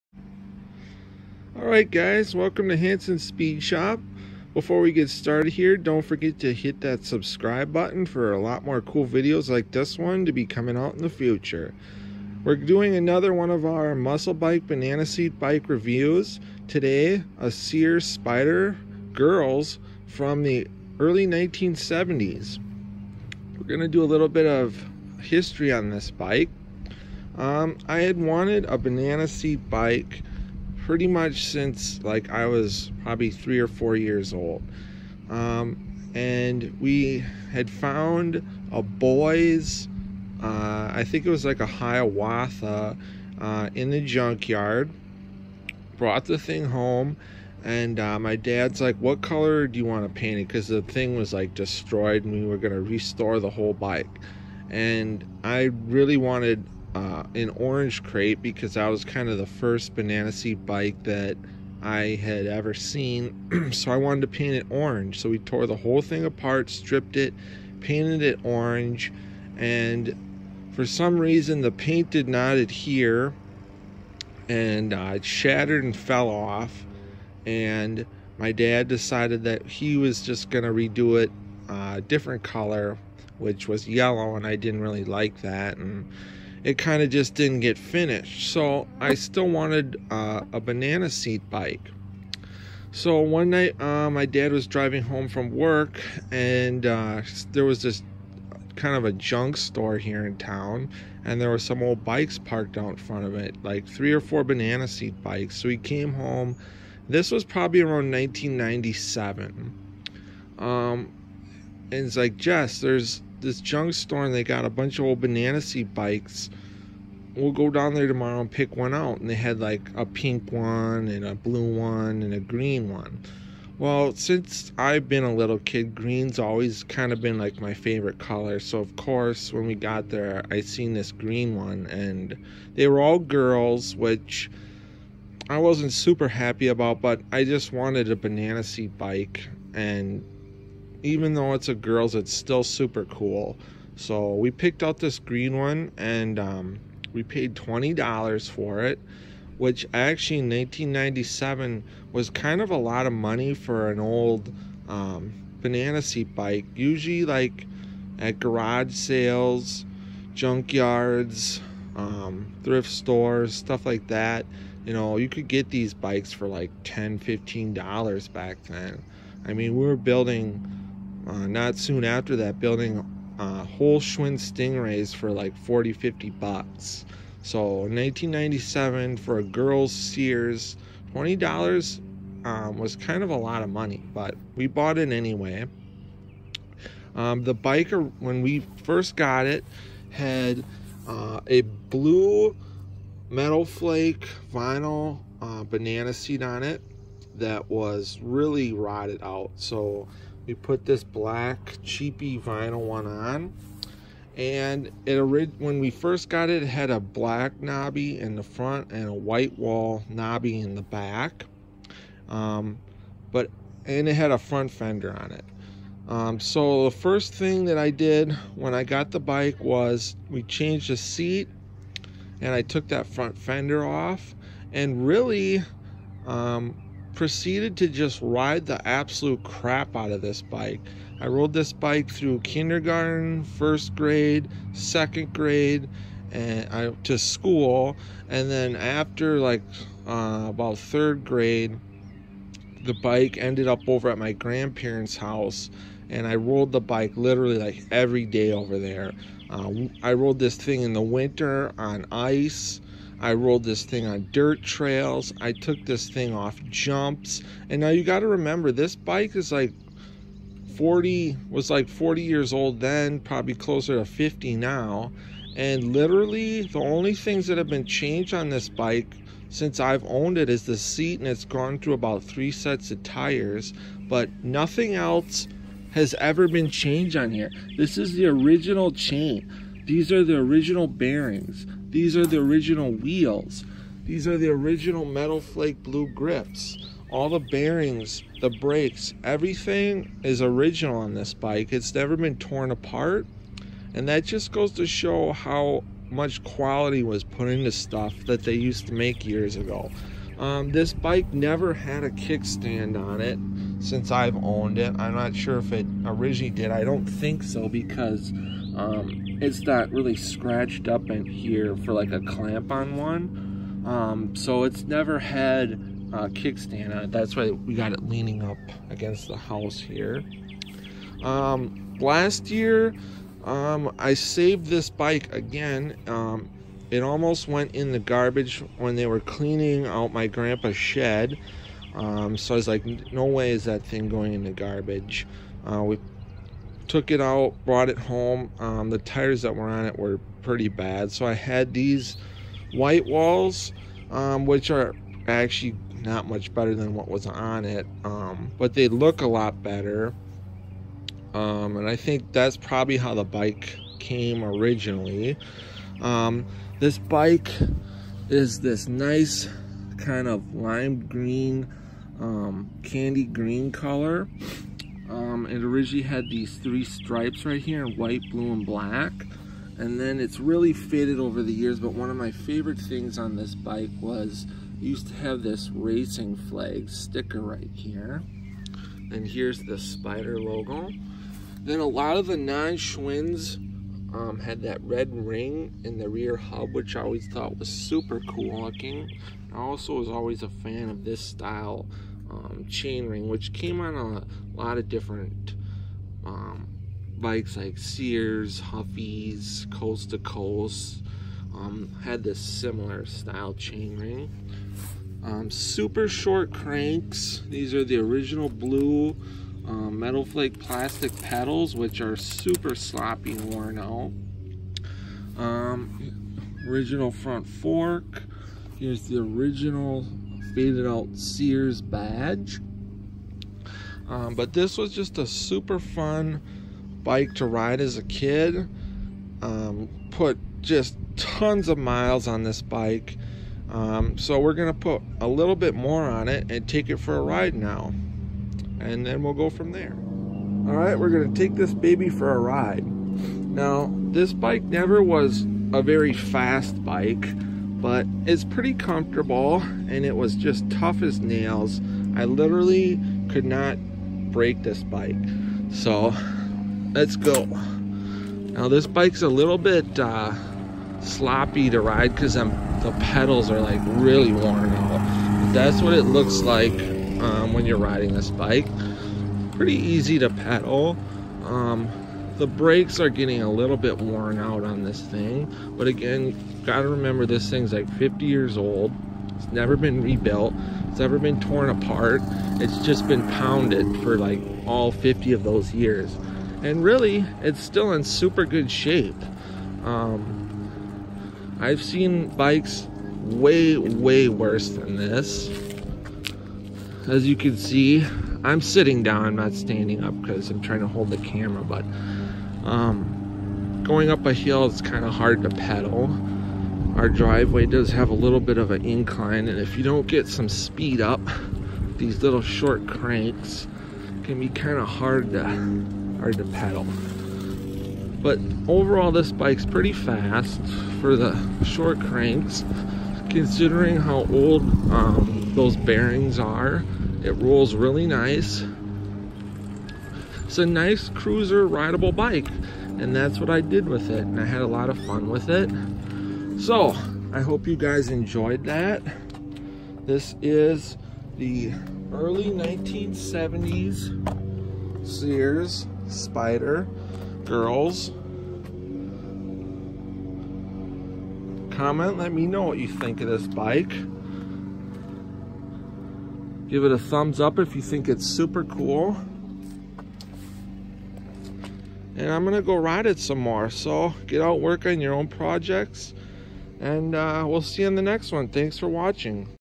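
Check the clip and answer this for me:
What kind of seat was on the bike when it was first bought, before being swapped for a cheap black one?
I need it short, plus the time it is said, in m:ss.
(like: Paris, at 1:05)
blue metal flake vinyl, at 3:11.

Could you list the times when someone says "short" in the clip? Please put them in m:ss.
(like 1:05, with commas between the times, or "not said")
6:46, 8:32, 8:41.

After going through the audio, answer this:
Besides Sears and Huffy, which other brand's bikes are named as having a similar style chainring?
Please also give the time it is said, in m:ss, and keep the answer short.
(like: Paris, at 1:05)
Coast to Coast, at 6:39.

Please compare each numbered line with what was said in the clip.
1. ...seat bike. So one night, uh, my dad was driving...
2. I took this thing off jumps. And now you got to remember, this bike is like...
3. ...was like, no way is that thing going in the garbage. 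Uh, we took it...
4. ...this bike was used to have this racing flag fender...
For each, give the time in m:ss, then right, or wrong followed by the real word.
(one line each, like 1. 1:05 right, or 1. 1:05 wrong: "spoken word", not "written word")
1. 1:31 right
2. 4:15 right
3. 5:32 right
4. 6:13 wrong: "sticker", not "fender".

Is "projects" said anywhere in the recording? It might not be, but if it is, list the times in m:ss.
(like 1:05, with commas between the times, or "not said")
9:25.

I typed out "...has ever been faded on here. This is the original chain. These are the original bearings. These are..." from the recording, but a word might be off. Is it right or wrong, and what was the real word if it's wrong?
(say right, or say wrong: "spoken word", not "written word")
wrong: "changed", not "faded".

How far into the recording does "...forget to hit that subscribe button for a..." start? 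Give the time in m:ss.
0:06.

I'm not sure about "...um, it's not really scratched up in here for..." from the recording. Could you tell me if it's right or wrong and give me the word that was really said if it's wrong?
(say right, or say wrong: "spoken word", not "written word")
right.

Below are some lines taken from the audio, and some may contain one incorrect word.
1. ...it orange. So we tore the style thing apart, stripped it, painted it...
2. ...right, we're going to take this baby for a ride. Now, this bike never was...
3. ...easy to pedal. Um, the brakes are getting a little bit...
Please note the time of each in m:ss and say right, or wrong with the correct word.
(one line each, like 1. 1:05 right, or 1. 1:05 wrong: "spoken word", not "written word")
1. 1:04 wrong: "whole", not "style"
2. 7:20 right
3. 7:49 right.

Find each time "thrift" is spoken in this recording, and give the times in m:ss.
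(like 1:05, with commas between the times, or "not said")
2:42.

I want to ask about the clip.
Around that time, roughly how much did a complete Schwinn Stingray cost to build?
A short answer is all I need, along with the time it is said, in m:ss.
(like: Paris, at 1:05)
$40 to $50, at 2:55.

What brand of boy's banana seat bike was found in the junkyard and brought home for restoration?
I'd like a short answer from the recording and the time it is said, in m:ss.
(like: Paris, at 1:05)
Hiawatha, at 0:41.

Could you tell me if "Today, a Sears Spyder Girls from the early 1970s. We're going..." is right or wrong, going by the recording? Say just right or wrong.
right.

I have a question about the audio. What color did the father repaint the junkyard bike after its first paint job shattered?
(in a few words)
yellow.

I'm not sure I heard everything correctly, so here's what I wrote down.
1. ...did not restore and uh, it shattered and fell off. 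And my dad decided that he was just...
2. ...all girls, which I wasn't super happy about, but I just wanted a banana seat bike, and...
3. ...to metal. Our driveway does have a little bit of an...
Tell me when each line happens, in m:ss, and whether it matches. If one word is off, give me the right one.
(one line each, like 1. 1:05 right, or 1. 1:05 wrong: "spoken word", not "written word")
1. 1:12 wrong: "adhere", not "restore"
2. 2:13 right
3. 8:25 wrong: "pedal", not "metal".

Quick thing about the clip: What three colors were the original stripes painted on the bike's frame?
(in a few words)
white, blue, and black.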